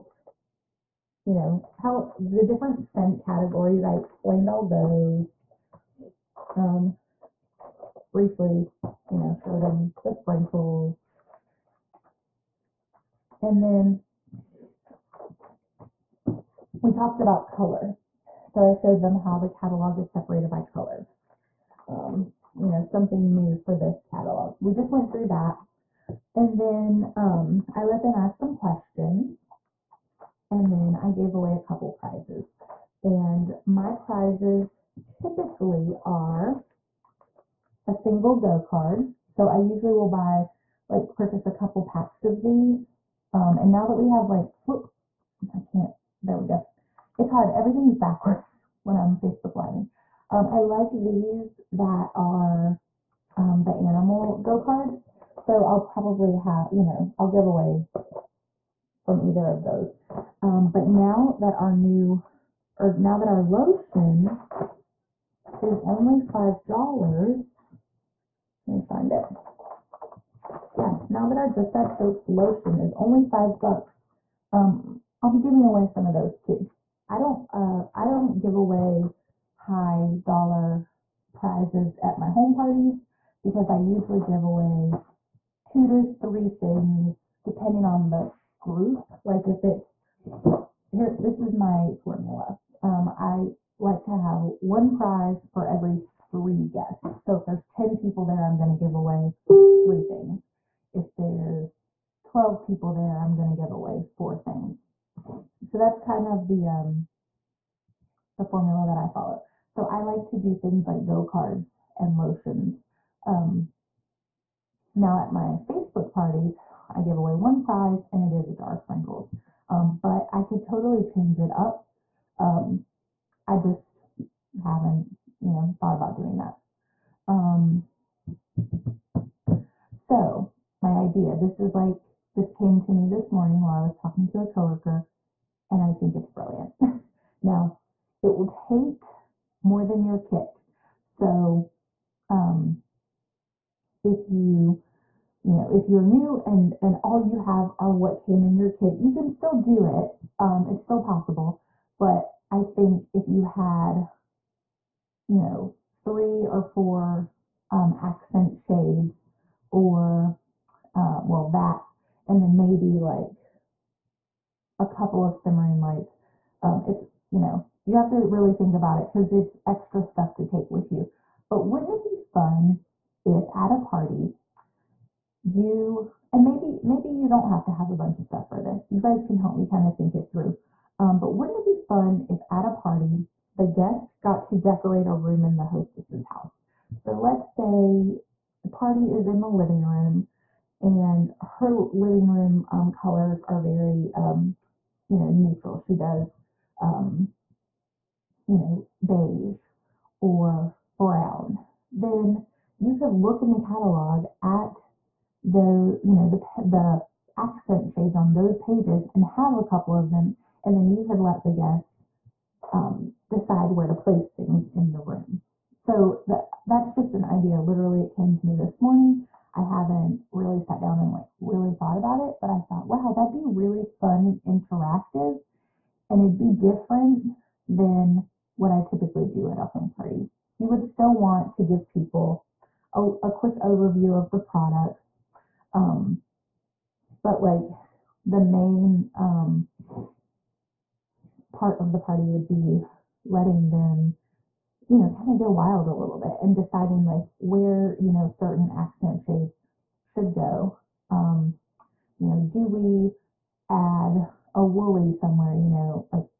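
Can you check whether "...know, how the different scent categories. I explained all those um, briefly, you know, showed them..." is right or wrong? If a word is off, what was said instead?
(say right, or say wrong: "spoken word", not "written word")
right.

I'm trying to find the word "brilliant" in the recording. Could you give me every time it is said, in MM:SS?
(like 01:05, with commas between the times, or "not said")
02:16.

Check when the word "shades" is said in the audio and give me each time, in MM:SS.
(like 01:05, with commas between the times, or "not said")
02:38, 03:27, 04:09.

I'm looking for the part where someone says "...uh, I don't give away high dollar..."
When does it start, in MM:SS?
01:17.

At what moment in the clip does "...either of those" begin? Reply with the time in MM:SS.
00:59.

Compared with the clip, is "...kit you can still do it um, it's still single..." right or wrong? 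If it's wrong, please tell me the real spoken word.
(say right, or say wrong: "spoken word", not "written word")
wrong: "possible", not "single".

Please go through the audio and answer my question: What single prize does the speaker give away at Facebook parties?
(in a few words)
a jar of sprinkles.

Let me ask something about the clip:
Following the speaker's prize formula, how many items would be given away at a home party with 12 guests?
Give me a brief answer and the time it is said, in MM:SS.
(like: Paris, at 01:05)
4, at 01:44.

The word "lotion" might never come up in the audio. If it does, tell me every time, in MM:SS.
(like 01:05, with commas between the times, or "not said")
01:03, 01:12, 01:52.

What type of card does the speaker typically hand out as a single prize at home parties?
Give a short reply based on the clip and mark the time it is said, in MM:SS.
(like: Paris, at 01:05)
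go card, at 00:38.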